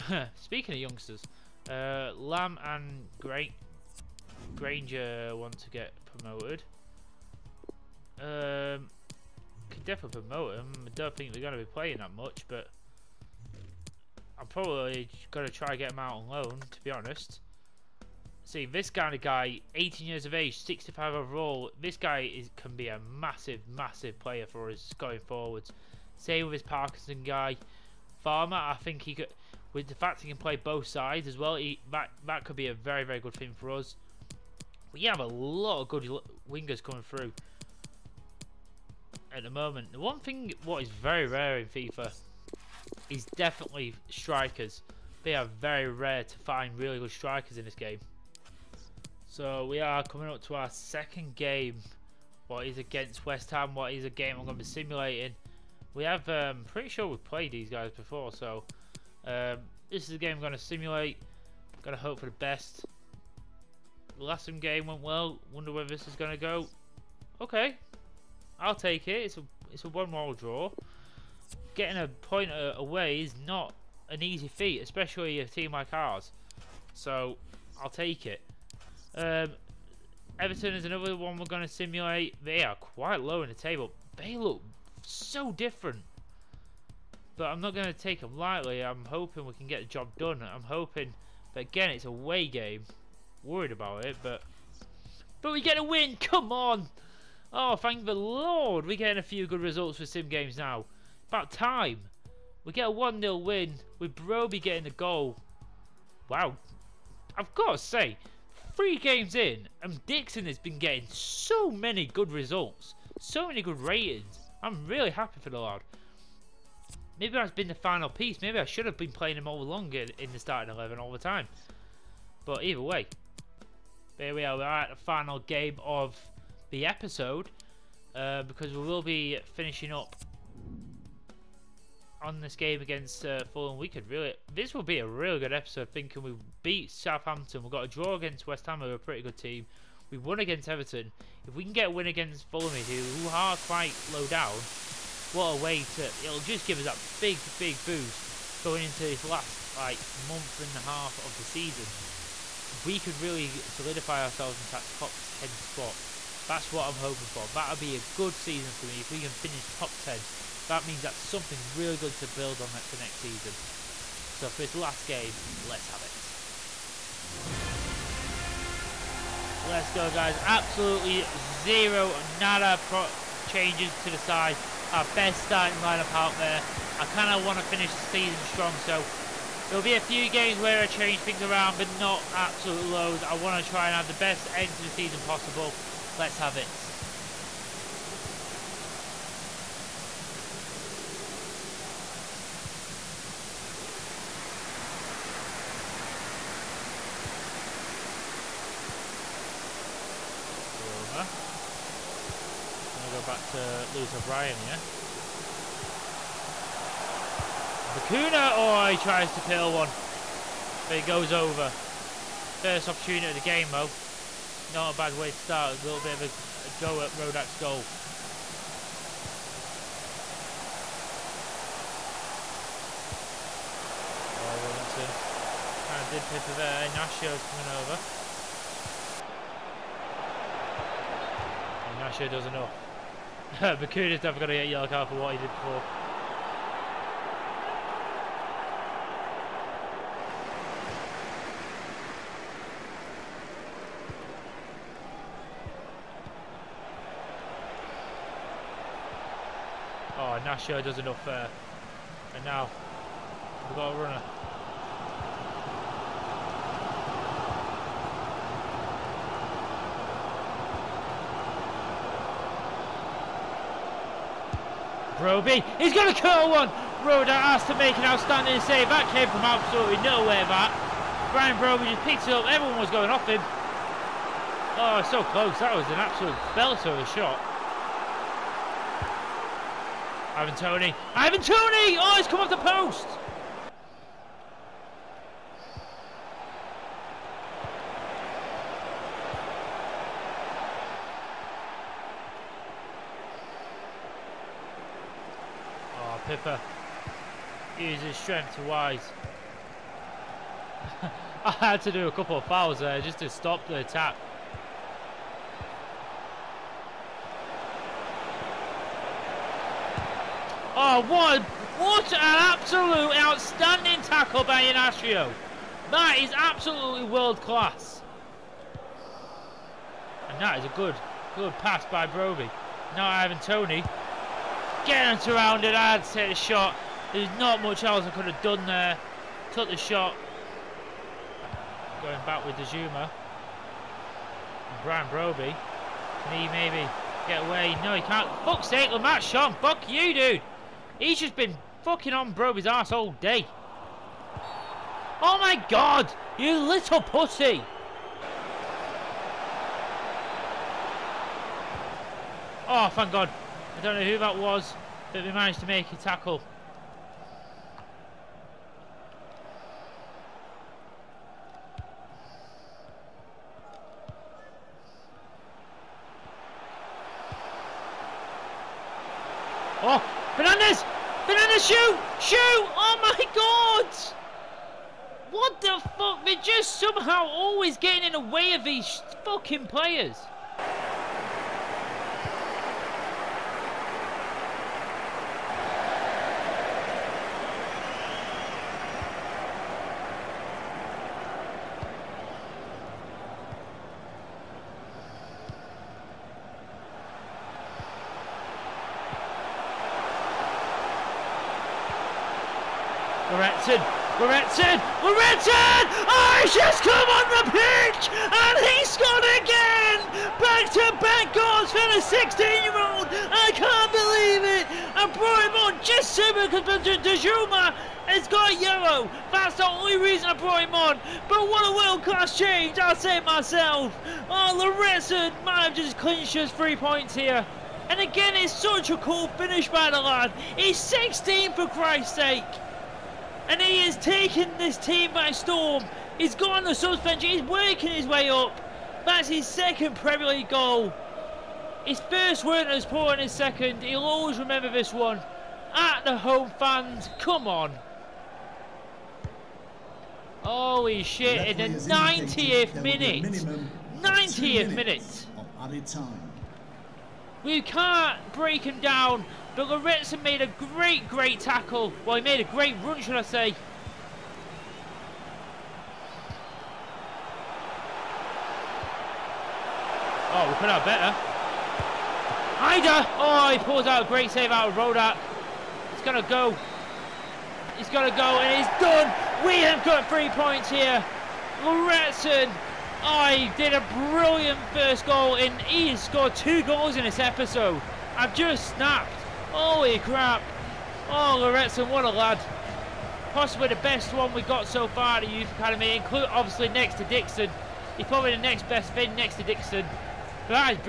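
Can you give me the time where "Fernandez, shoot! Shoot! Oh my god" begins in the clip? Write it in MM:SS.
06:11.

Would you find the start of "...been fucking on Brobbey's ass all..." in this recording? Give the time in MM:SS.
05:41.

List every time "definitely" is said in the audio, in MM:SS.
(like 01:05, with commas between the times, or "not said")
00:09, 00:43.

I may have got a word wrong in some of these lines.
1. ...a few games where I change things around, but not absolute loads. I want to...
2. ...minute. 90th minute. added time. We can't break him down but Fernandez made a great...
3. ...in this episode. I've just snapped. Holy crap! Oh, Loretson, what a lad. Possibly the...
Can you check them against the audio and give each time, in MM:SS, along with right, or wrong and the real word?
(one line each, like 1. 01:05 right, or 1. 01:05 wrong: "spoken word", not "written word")
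1. 02:59 right
2. 07:32 wrong: "Lorentzen", not "Fernandez"
3. 08:06 right.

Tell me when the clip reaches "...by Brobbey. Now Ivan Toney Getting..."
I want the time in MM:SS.
05:21.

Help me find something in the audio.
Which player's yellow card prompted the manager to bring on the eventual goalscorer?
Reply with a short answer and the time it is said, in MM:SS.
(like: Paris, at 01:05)
Dejuma, at 06:56.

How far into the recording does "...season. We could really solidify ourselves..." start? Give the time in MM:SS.
02:31.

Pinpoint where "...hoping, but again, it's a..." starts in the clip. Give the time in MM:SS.
01:30.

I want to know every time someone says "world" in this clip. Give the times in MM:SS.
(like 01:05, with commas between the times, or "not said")
05:17, 07:01.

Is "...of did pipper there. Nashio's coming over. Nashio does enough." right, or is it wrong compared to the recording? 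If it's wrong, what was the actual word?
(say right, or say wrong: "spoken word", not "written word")
right.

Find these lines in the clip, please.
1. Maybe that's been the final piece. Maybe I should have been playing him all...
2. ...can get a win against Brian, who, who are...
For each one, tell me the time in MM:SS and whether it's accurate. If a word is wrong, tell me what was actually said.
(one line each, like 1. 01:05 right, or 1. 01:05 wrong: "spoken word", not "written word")
1. 01:57 right
2. 02:21 wrong: "Fulham", not "Brian".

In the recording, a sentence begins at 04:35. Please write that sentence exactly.
That was an absolute belter of a shot.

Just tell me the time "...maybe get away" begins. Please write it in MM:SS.
05:36.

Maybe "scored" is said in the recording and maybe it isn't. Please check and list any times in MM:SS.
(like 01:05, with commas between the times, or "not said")
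06:48, 08:06.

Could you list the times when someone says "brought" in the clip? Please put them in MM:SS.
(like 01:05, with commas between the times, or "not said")
06:55, 07:00.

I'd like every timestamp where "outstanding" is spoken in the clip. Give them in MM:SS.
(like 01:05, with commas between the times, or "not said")
04:28, 05:13.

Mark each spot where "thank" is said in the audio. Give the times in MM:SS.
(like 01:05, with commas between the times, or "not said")
01:37, 05:52.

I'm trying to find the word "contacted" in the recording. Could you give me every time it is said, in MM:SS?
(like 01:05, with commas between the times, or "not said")
not said.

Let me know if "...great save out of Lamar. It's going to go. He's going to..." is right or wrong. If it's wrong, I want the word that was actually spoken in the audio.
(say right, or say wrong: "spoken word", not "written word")
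wrong: "Rodak", not "Lamar".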